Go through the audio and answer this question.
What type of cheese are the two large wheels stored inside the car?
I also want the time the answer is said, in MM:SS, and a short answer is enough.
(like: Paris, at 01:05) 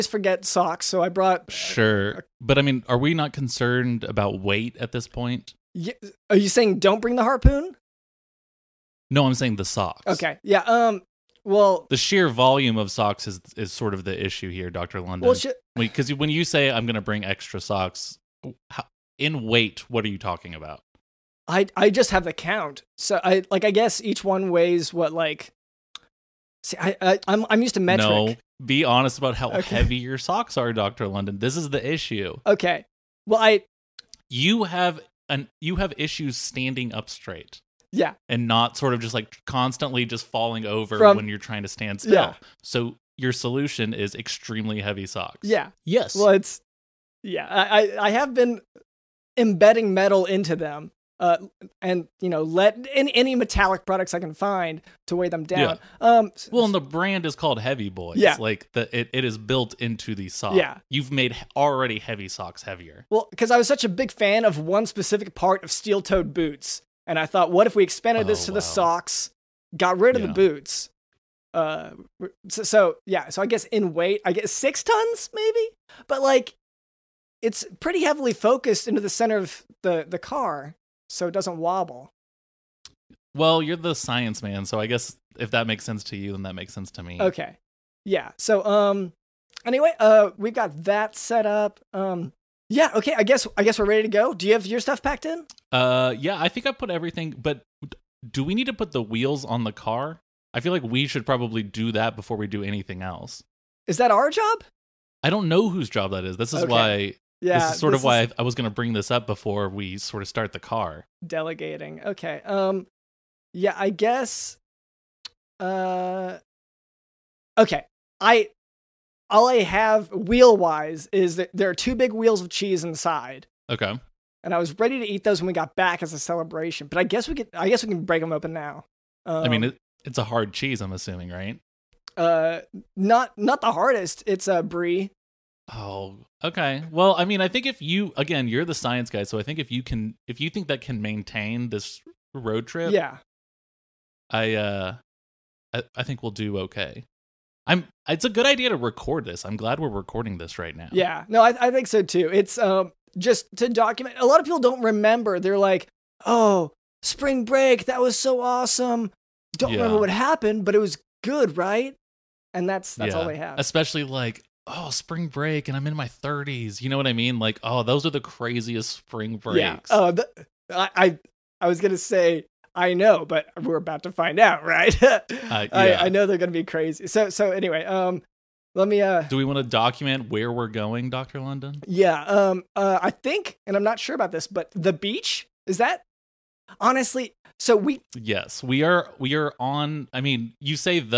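Brie, at 02:14.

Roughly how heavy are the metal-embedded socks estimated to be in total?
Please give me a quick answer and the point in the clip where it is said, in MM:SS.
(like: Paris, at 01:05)
6 tons, at 01:14.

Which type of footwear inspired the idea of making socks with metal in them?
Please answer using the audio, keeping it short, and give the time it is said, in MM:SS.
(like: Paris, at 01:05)
Steel toed boots, at 01:05.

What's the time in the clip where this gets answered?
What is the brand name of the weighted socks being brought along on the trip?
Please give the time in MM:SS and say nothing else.
00:57.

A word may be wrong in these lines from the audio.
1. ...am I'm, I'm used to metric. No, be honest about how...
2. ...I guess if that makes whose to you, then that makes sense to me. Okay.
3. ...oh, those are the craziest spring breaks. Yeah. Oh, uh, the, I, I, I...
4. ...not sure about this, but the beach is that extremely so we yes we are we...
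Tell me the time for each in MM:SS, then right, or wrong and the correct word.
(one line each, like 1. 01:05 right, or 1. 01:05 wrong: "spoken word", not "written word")
1. 00:27 right
2. 01:24 wrong: "sense", not "whose"
3. 02:47 right
4. 03:03 wrong: "honestly", not "extremely".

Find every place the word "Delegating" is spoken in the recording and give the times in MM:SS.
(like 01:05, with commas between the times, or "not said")
01:51.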